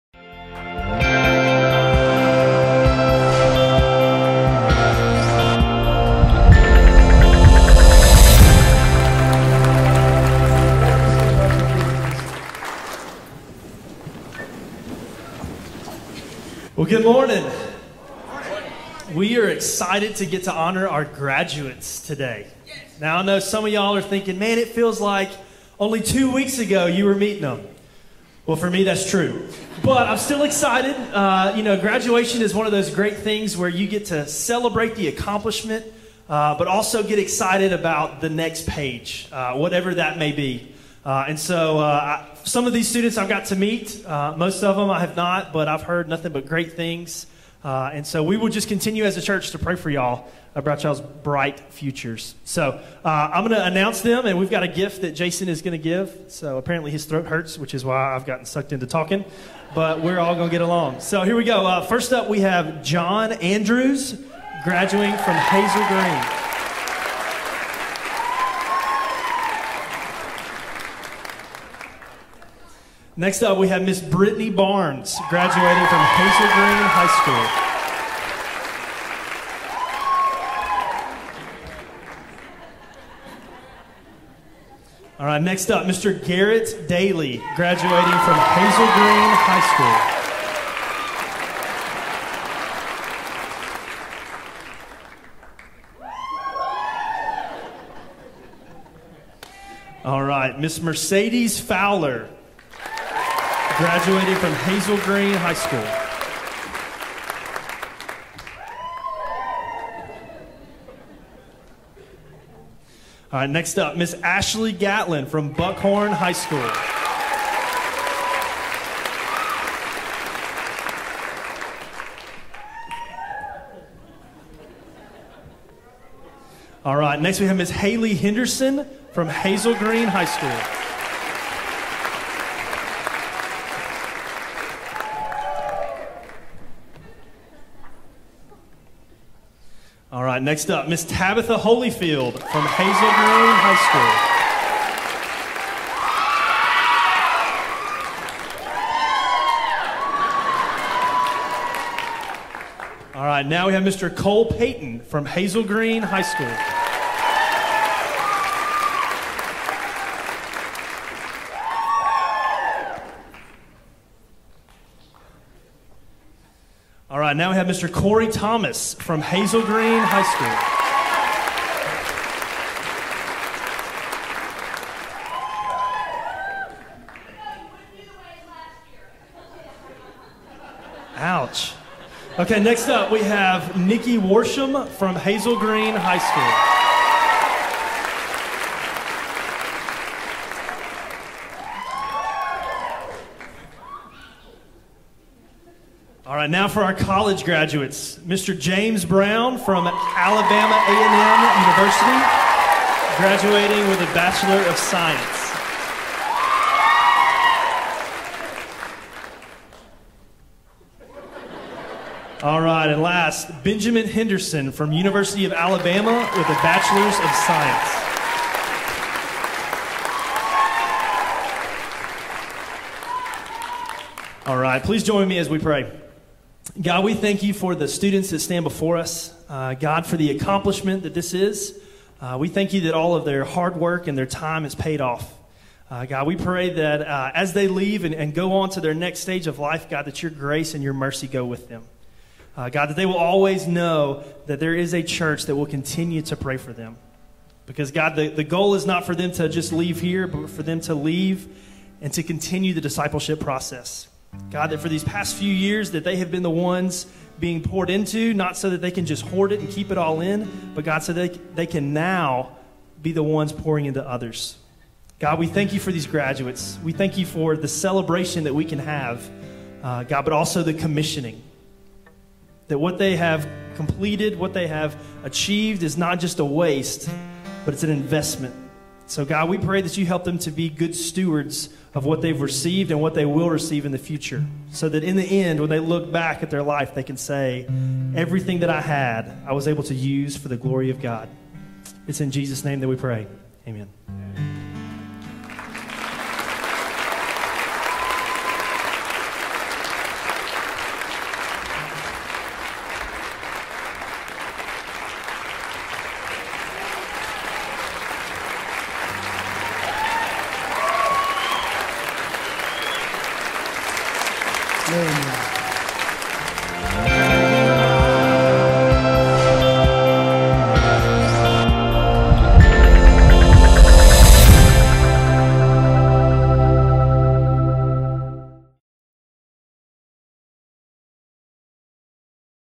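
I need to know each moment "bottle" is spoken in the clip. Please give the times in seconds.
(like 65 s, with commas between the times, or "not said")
not said.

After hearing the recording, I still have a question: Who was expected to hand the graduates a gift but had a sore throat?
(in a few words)
Jason.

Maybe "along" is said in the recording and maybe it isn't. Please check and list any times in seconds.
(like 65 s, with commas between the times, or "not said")
60 s.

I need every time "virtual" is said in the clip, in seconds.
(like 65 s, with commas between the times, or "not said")
not said.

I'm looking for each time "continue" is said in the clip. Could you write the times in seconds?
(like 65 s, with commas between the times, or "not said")
48 s, 245 s, 252 s.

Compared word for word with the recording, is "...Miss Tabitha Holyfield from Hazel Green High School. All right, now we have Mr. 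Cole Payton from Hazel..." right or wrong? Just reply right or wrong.
right.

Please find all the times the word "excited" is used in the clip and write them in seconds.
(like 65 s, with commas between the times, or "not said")
19 s, 30 s, 37 s.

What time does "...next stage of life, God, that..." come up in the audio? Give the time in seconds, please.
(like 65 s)
238 s.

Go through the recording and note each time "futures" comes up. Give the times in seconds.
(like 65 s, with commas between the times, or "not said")
51 s, 283 s.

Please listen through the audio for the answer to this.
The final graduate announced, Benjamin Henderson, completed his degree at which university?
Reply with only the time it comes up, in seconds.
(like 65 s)
214 s.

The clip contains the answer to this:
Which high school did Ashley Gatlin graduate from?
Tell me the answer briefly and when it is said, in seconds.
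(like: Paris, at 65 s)
Buckhorn High School, at 115 s.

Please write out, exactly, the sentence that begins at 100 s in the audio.
All right, Miss Mercedes Fowler, graduating from Hazel Green High School.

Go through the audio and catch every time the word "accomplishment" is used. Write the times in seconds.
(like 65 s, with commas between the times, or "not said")
35 s, 230 s.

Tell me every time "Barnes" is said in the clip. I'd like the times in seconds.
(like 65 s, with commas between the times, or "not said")
74 s.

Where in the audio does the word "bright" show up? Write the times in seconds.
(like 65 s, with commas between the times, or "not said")
51 s.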